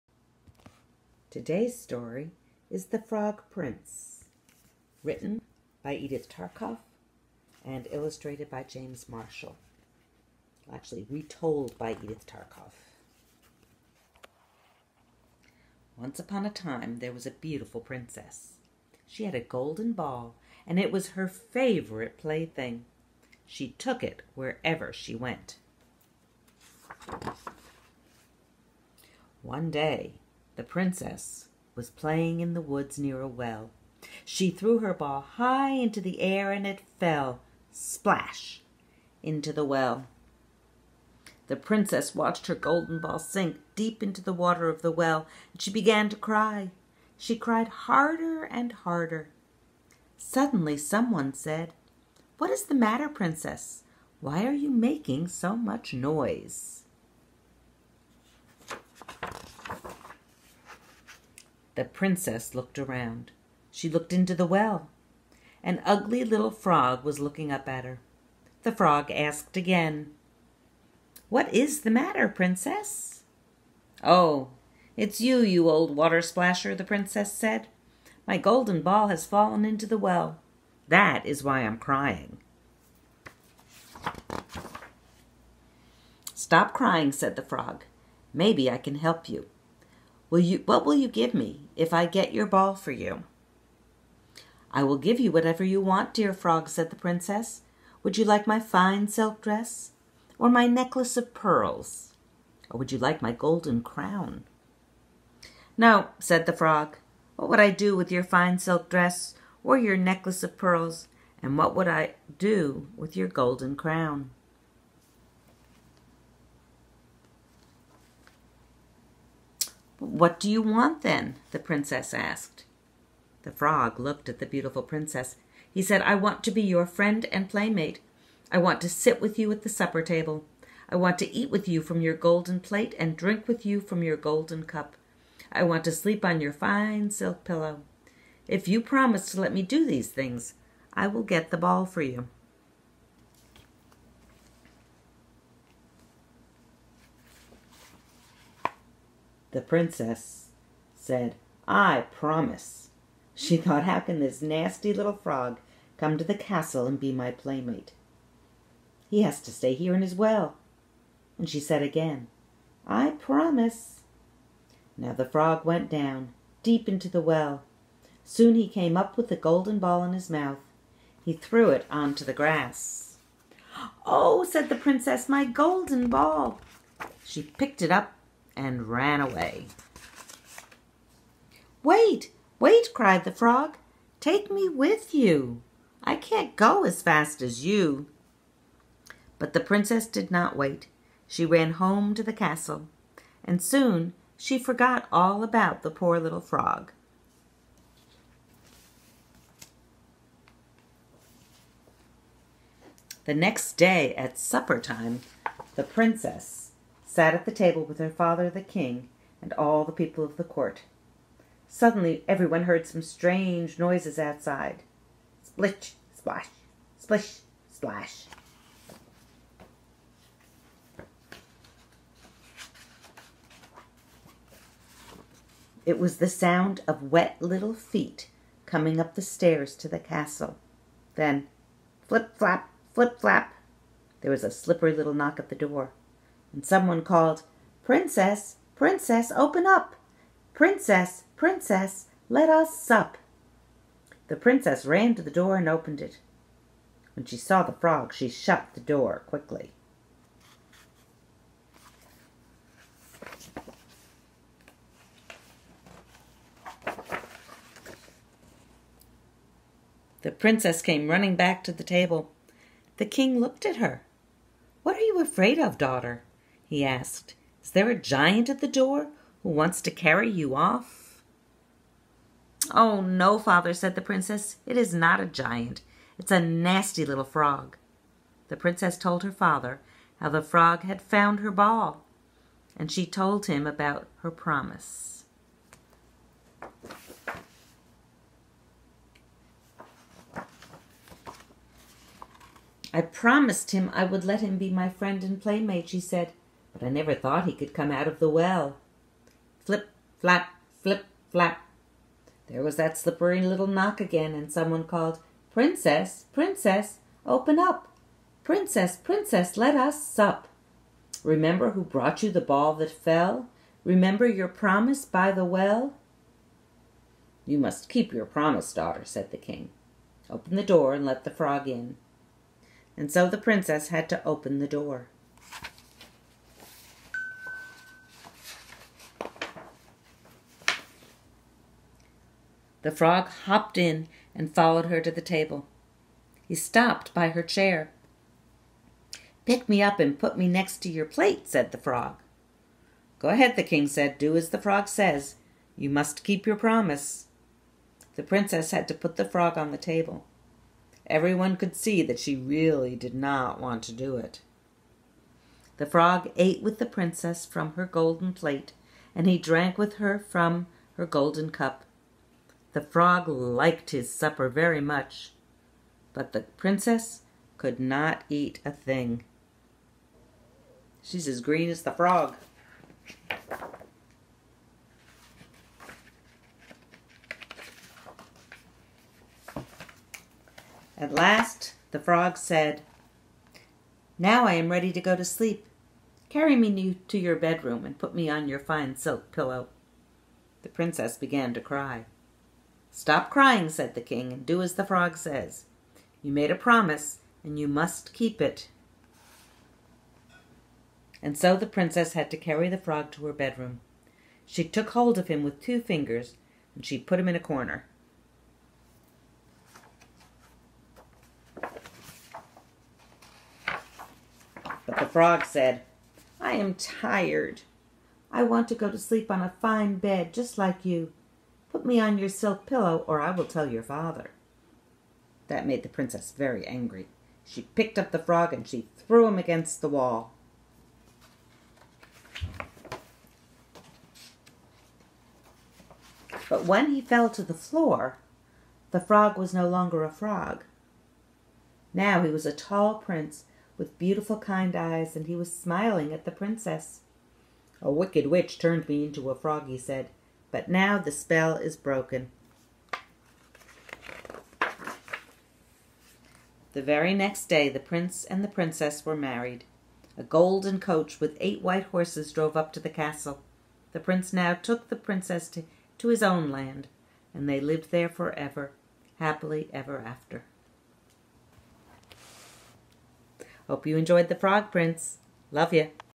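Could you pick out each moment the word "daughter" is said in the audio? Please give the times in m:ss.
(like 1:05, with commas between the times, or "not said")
4:25, 5:18.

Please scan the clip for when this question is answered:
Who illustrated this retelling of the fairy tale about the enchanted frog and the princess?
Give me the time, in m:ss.
0:08.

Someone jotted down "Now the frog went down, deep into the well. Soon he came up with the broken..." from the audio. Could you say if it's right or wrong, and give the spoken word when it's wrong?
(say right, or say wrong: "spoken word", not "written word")
wrong: "golden", not "broken".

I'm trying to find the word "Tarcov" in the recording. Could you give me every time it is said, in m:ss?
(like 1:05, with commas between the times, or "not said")
0:06, 0:12.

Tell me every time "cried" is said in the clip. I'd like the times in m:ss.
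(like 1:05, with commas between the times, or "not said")
0:47, 3:02.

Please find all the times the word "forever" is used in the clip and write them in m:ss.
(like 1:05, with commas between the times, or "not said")
7:48.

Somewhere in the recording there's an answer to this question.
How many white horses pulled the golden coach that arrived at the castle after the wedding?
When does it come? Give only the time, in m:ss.
7:41.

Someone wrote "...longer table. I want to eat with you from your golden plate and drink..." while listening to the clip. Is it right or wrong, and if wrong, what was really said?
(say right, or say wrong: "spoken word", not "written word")
wrong: "supper", not "longer".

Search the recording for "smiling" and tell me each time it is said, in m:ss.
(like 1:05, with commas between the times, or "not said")
7:25.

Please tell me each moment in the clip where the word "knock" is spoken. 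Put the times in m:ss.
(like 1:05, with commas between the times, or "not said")
3:55, 5:03.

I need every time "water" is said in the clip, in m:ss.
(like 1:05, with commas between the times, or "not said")
0:44, 1:15.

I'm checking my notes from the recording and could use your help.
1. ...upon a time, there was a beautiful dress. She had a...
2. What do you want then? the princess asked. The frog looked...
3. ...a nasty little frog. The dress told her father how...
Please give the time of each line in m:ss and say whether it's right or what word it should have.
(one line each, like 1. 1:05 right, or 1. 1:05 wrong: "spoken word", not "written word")
1. 0:16 wrong: "princess", not "dress"
2. 2:00 right
3. 4:36 wrong: "princess", not "dress".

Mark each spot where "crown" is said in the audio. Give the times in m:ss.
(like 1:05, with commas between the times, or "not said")
1:43, 1:53.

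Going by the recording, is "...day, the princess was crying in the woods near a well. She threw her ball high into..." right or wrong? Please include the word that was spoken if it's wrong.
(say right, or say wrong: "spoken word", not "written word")
wrong: "playing", not "crying".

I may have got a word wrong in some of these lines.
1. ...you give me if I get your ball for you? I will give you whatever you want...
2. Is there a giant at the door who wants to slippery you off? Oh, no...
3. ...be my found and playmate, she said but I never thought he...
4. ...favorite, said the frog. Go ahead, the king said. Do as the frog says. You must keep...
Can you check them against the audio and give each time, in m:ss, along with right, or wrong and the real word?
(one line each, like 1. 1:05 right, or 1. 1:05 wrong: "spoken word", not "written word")
1. 1:30 right
2. 4:27 wrong: "carry", not "slippery"
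3. 4:54 wrong: "friend", not "found"
4. 5:41 wrong: "plate", not "favorite".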